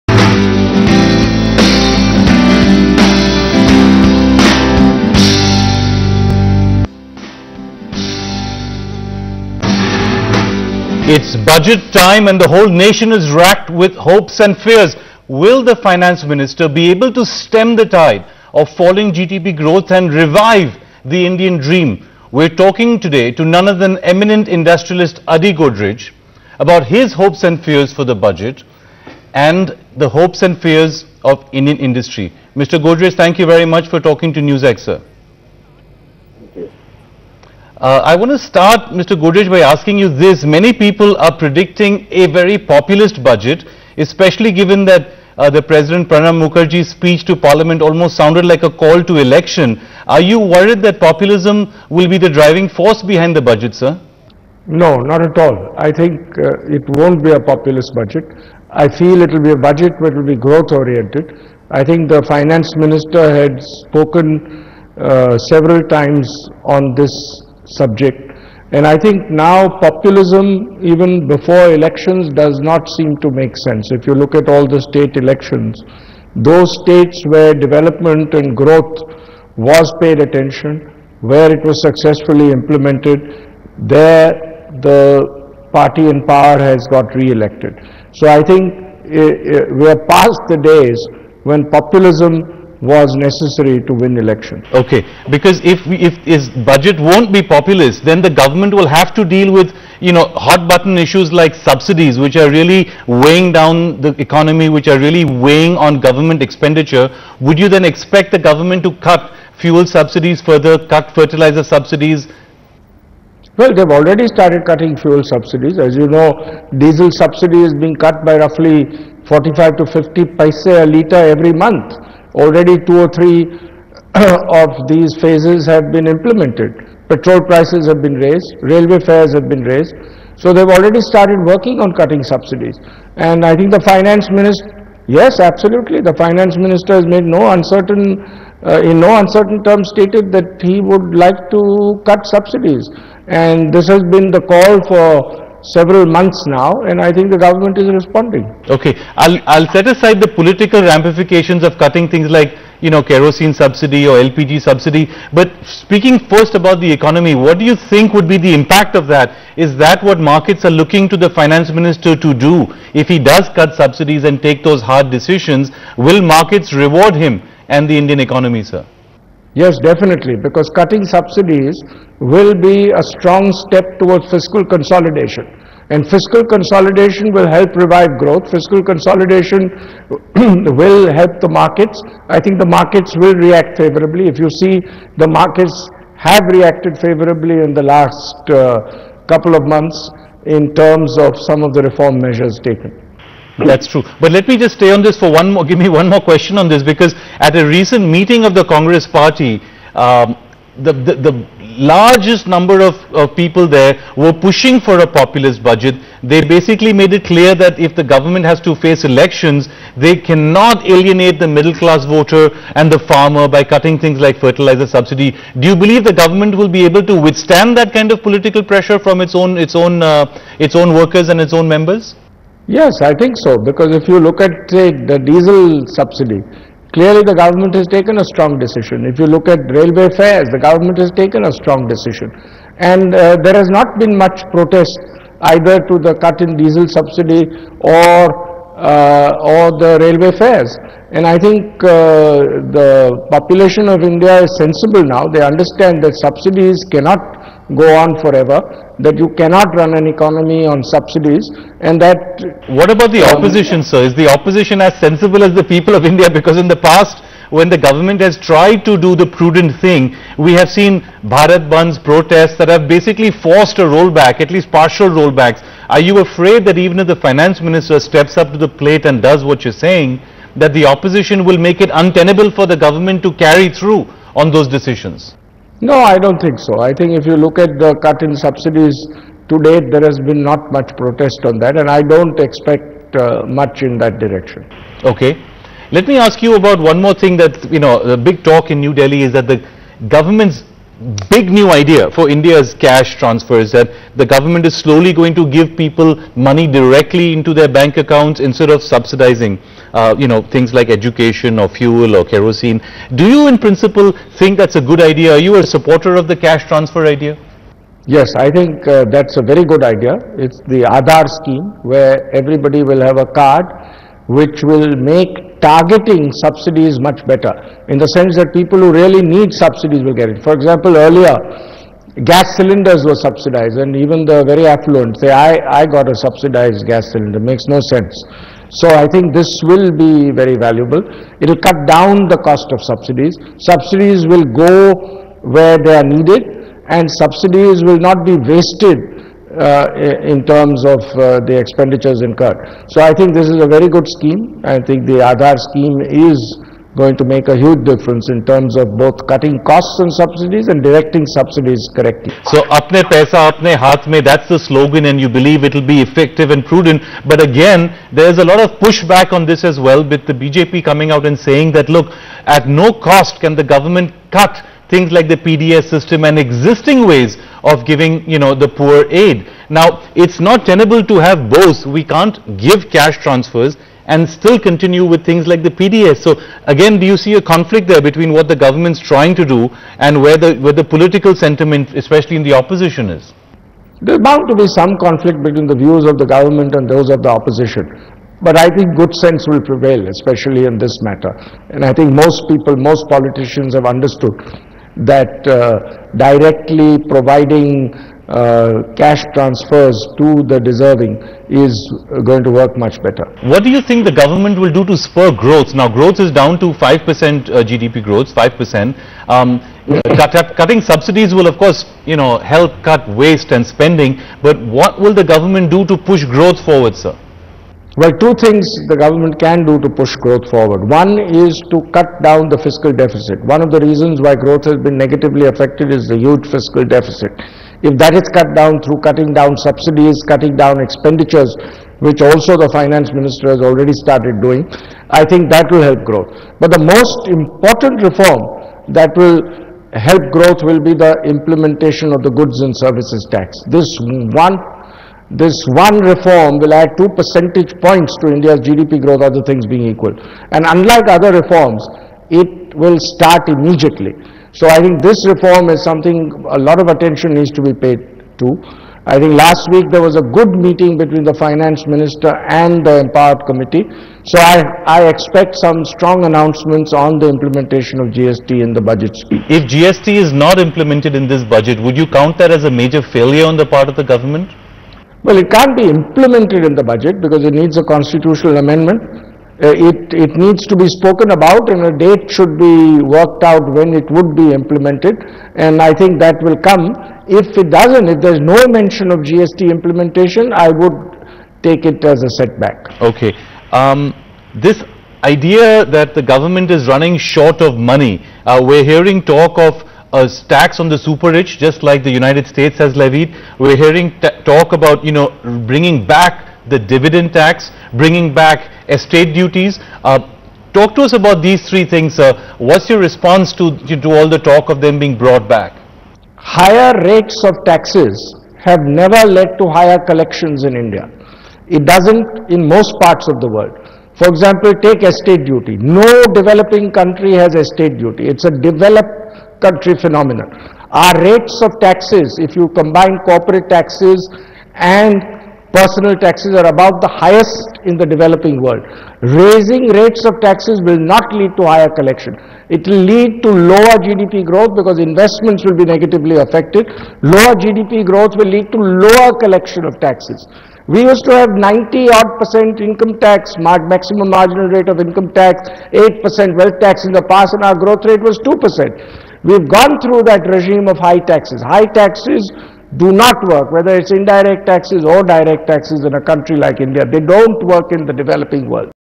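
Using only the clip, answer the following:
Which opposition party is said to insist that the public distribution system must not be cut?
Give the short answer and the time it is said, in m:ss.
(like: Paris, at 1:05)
BJP, at 6:00.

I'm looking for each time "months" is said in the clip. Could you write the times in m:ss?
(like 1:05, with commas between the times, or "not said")
2:01, 2:26, 3:09.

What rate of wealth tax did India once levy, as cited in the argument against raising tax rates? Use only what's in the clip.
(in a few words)
8 percent.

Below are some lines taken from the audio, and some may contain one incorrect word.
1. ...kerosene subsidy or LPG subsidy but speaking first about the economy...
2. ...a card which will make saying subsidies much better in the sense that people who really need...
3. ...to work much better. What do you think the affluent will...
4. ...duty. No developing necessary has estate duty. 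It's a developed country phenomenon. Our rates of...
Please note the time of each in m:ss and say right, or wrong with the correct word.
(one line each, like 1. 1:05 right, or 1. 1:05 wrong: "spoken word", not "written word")
1. 2:33 right
2. 5:13 wrong: "targeting", not "saying"
3. 6:42 wrong: "government", not "affluent"
4. 8:45 wrong: "country", not "necessary".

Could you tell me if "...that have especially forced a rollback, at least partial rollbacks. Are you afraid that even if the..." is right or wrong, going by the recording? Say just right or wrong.
wrong.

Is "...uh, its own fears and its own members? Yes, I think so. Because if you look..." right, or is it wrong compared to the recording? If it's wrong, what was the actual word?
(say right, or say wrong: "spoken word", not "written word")
wrong: "workers", not "fears".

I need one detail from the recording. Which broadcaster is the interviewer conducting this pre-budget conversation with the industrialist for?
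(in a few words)
NewsX.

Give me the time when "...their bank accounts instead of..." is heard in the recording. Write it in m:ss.
4:57.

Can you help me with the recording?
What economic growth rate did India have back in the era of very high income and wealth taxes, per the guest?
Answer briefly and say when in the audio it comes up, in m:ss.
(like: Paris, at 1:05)
2 percent, at 9:17.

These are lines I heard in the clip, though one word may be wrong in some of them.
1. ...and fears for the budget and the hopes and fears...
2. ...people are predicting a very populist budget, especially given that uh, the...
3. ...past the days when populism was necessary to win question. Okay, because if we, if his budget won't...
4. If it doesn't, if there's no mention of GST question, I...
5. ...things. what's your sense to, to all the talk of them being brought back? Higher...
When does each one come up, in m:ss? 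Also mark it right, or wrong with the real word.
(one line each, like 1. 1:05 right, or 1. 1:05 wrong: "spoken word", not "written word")
1. 0:27 right
2. 0:40 right
3. 1:30 wrong: "election", not "question"
4. 8:07 wrong: "implementation", not "question"
5. 8:31 wrong: "response", not "sense".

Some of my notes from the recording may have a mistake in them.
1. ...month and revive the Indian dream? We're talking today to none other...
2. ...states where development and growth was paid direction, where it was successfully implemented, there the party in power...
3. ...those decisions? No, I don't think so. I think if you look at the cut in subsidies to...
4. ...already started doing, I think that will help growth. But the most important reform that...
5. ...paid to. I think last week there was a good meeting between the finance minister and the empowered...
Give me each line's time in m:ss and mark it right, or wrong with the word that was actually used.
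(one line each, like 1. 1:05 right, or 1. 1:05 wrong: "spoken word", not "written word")
1. 0:19 wrong: "growth", not "month"
2. 1:16 wrong: "attention", not "direction"
3. 4:34 right
4. 7:13 right
5. 7:37 right.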